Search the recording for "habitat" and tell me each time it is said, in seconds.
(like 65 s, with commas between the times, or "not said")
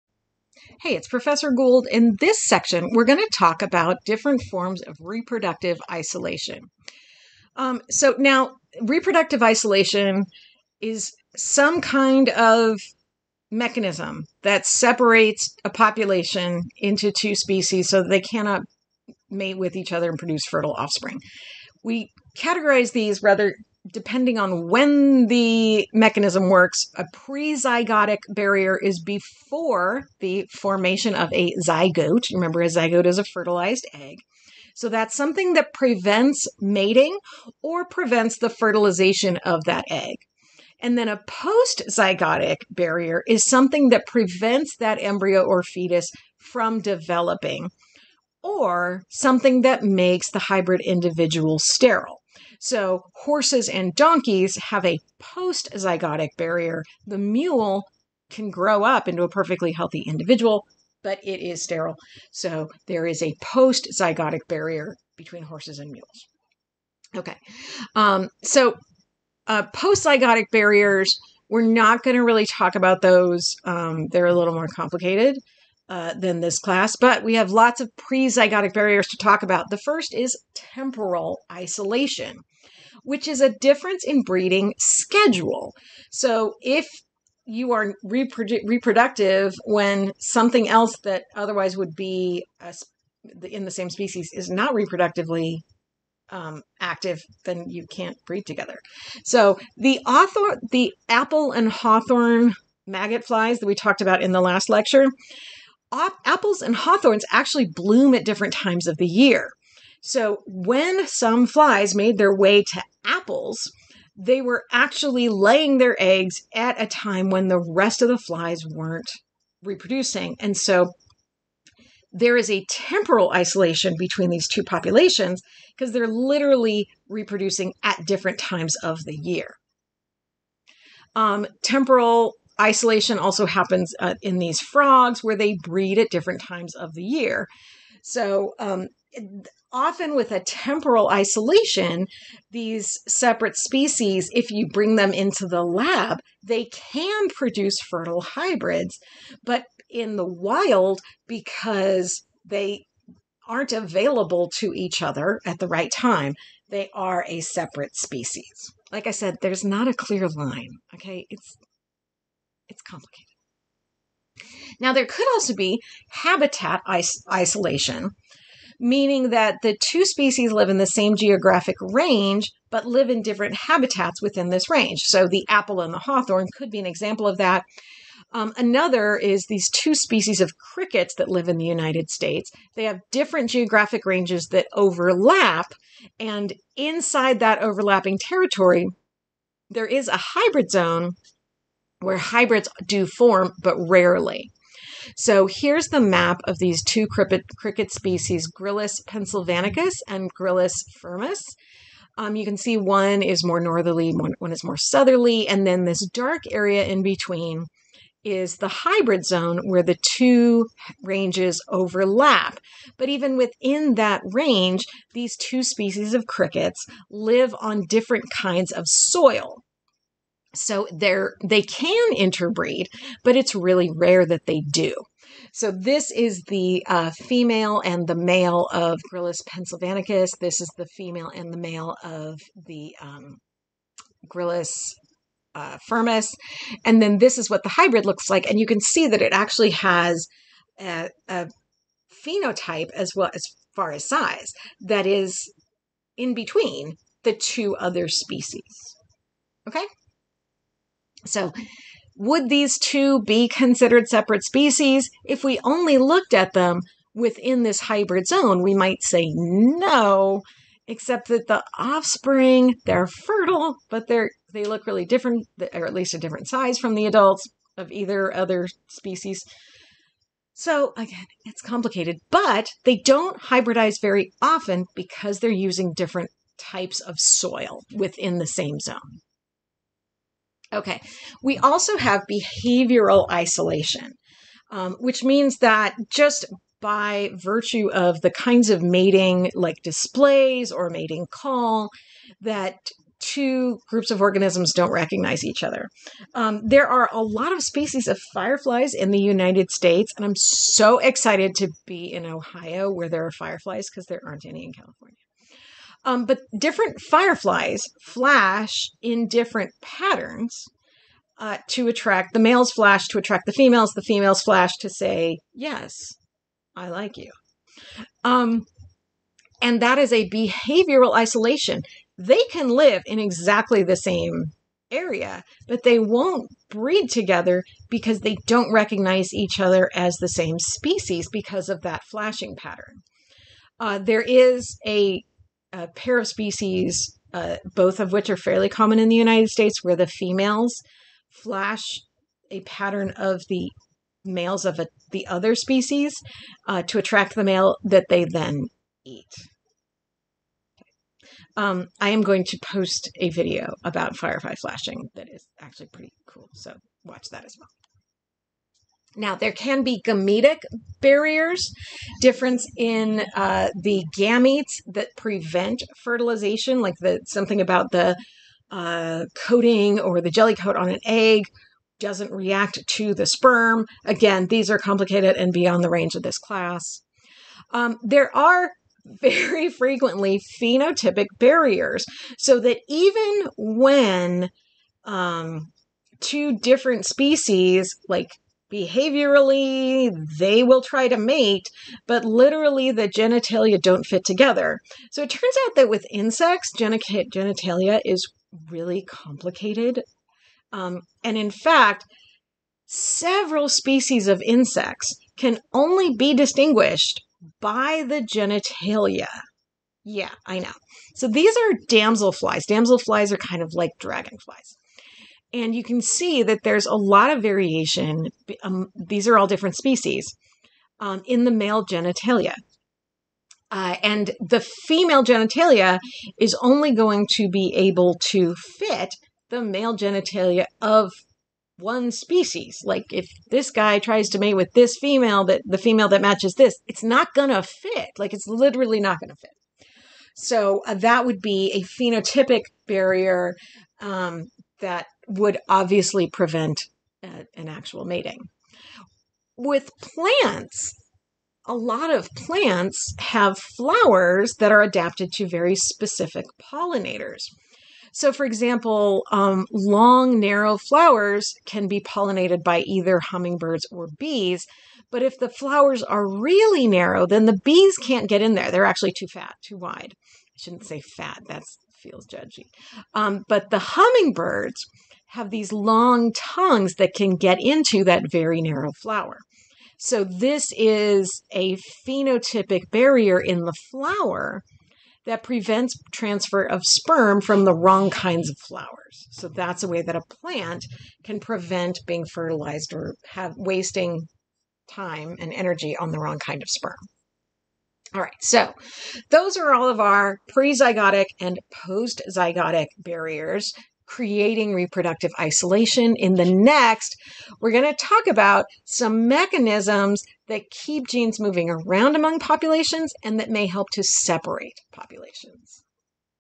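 166 s, 173 s.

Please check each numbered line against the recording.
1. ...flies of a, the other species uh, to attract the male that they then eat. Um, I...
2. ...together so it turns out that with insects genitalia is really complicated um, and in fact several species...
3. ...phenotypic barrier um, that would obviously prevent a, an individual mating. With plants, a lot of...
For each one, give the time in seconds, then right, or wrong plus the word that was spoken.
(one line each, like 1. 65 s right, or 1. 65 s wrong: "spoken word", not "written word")
1. 344 s wrong: "males", not "flies"
2. 394 s right
3. 441 s wrong: "actual", not "individual".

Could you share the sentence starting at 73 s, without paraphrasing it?
Um, they're a little more complicated.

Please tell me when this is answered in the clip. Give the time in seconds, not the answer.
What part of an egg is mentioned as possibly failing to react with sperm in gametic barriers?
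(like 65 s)
370 s.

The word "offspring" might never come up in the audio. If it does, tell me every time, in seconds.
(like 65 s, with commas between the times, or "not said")
20 s, 261 s.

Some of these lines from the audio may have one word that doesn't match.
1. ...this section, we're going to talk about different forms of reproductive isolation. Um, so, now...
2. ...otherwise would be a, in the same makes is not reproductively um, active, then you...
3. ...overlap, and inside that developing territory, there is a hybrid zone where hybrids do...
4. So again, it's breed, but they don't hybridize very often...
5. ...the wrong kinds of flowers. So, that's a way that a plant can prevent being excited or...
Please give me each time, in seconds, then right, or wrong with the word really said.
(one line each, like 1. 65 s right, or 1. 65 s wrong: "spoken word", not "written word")
1. 2 s right
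2. 91 s wrong: "species", not "makes"
3. 184 s wrong: "overlapping", not "developing"
4. 270 s wrong: "complicated", not "breed"
5. 487 s wrong: "fertilized", not "excited".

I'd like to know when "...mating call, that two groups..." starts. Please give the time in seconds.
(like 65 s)
290 s.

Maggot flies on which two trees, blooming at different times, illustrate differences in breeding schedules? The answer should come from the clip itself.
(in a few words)
Apples and hawthorns.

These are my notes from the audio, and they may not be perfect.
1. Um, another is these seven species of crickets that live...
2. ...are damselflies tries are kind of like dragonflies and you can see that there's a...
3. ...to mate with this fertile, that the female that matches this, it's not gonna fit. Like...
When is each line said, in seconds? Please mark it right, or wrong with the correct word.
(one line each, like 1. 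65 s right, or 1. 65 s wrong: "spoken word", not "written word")
1. 178 s wrong: "two", not "seven"
2. 411 s wrong: "damselflies", not "tries"
3. 434 s wrong: "female", not "fertile".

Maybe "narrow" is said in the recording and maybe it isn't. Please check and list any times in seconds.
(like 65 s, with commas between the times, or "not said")
460 s, 466 s, 478 s.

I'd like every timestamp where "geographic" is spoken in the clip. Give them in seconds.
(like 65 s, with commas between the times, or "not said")
171 s, 183 s.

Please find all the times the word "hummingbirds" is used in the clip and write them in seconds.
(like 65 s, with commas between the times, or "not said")
463 s, 473 s.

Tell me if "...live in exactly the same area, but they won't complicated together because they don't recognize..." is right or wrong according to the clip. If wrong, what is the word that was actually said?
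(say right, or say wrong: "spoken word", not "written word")
wrong: "breed", not "complicated".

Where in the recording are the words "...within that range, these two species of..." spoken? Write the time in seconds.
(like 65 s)
213 s.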